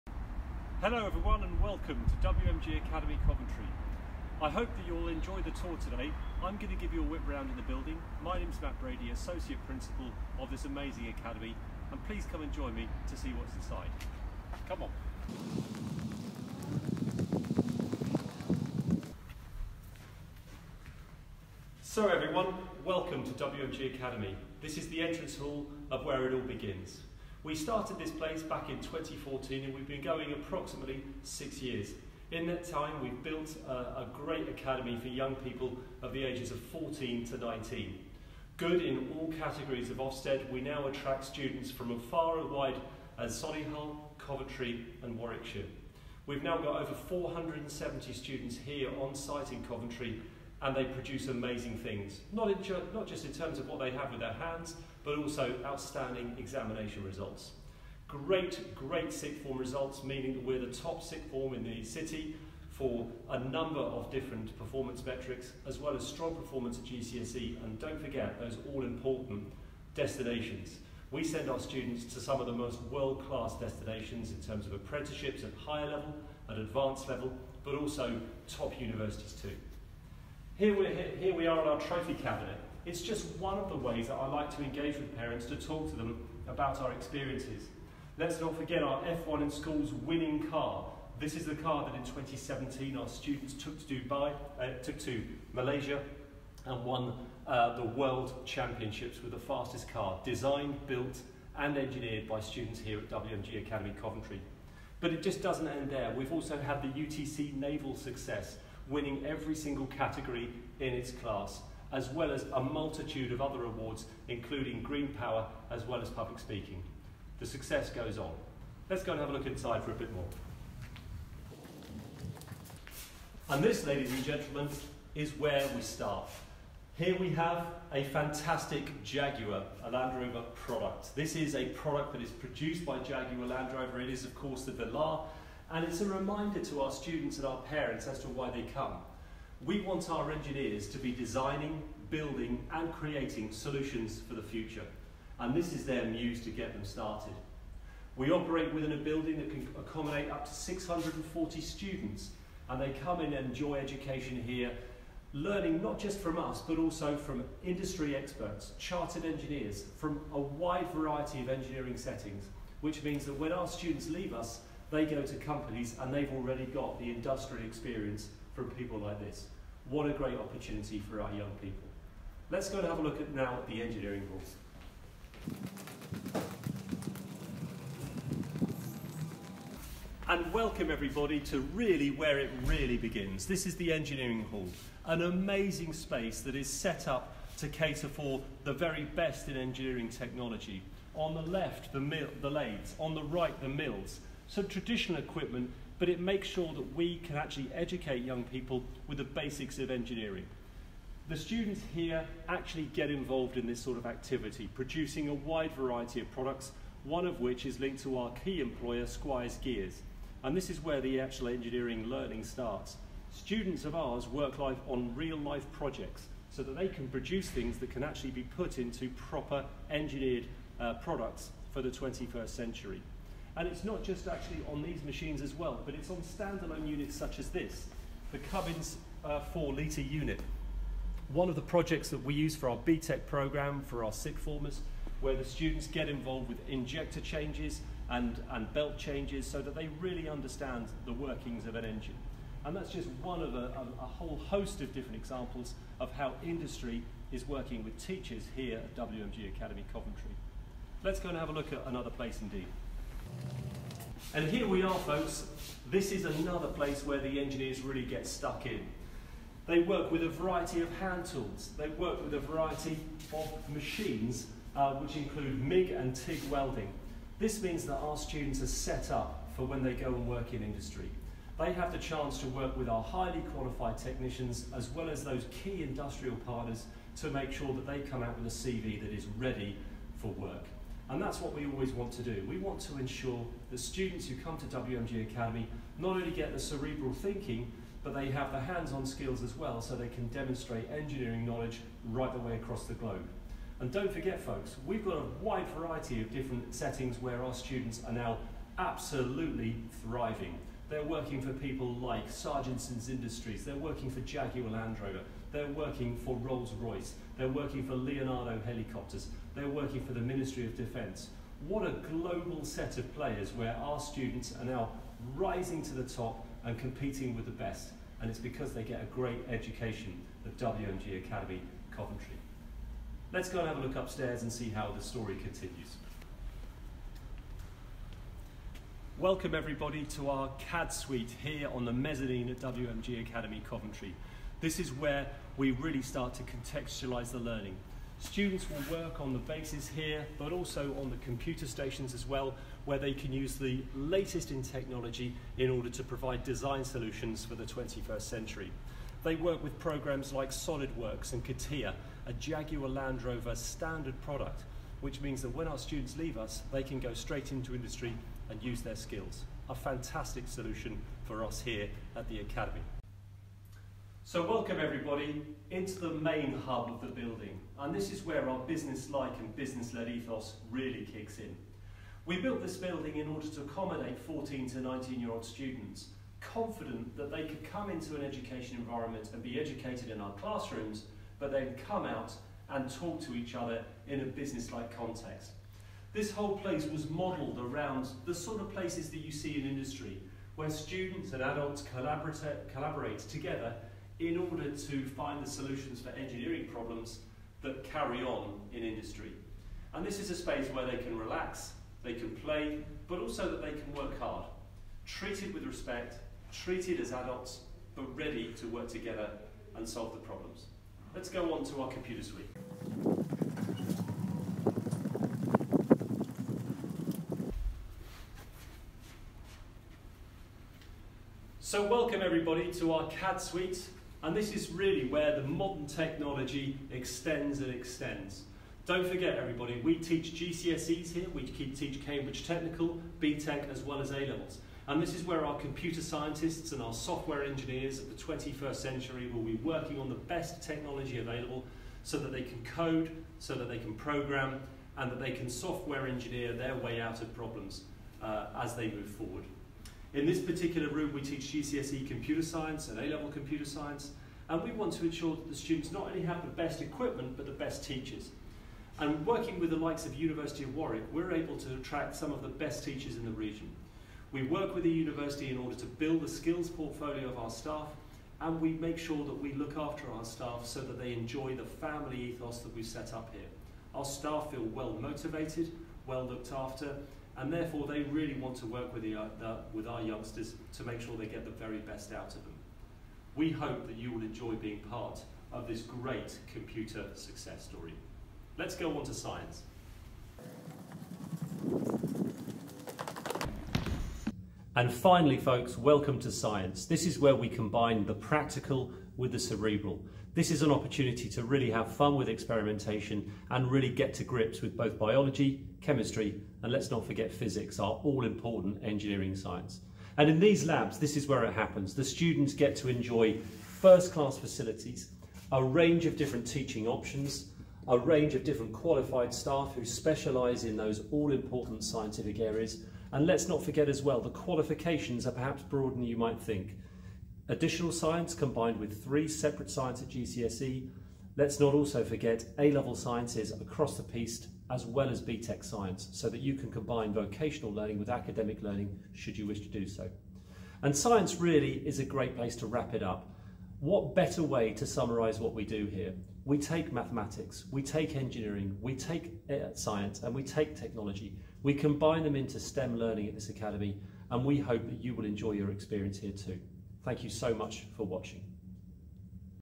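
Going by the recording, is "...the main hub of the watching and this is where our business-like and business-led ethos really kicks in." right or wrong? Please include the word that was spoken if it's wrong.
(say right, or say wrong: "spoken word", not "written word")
wrong: "building", not "watching".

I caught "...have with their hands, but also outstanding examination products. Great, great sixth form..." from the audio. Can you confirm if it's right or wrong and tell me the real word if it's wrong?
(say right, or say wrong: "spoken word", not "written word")
wrong: "results", not "products".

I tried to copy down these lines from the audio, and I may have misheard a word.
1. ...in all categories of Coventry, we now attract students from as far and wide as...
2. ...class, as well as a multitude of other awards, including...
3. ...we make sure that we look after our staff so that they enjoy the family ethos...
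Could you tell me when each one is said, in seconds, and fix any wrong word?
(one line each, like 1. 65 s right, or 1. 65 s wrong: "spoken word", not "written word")
1. 38 s wrong: "Ofsted", not "Coventry"
2. 111 s right
3. 468 s right.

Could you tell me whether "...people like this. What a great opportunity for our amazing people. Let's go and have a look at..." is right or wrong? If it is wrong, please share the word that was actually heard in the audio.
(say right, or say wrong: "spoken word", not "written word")
wrong: "young", not "amazing".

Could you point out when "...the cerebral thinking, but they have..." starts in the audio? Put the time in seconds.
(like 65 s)
286 s.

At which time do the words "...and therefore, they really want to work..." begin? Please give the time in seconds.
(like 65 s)
477 s.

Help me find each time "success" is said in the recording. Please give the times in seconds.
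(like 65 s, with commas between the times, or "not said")
107 s, 117 s, 487 s.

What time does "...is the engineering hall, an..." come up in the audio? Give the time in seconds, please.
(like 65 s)
183 s.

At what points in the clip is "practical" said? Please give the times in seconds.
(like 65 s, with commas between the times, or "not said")
498 s.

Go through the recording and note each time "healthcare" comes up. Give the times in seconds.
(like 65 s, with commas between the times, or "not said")
not said.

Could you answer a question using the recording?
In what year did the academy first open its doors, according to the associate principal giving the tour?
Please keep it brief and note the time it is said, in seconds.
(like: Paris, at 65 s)
2014, at 28 s.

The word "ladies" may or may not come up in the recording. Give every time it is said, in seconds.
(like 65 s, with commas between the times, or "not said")
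123 s.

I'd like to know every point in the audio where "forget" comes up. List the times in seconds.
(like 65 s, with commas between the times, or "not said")
67 s, 88 s, 294 s, 429 s, 507 s, 523 s, 532 s.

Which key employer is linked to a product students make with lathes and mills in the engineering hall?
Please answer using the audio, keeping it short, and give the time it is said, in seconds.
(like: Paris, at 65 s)
Squires Gears, at 209 s.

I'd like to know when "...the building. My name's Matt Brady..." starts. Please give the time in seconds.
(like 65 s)
7 s.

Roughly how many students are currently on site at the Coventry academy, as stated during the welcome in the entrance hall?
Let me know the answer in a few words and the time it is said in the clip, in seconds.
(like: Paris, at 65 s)
over 470, at 46 s.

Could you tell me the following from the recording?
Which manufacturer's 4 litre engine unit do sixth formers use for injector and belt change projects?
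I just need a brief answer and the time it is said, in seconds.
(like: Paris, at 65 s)
Cummins, at 228 s.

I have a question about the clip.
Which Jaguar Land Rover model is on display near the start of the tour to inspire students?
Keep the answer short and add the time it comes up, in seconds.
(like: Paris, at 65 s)
Velar, at 134 s.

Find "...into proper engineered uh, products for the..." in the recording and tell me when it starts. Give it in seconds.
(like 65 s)
218 s.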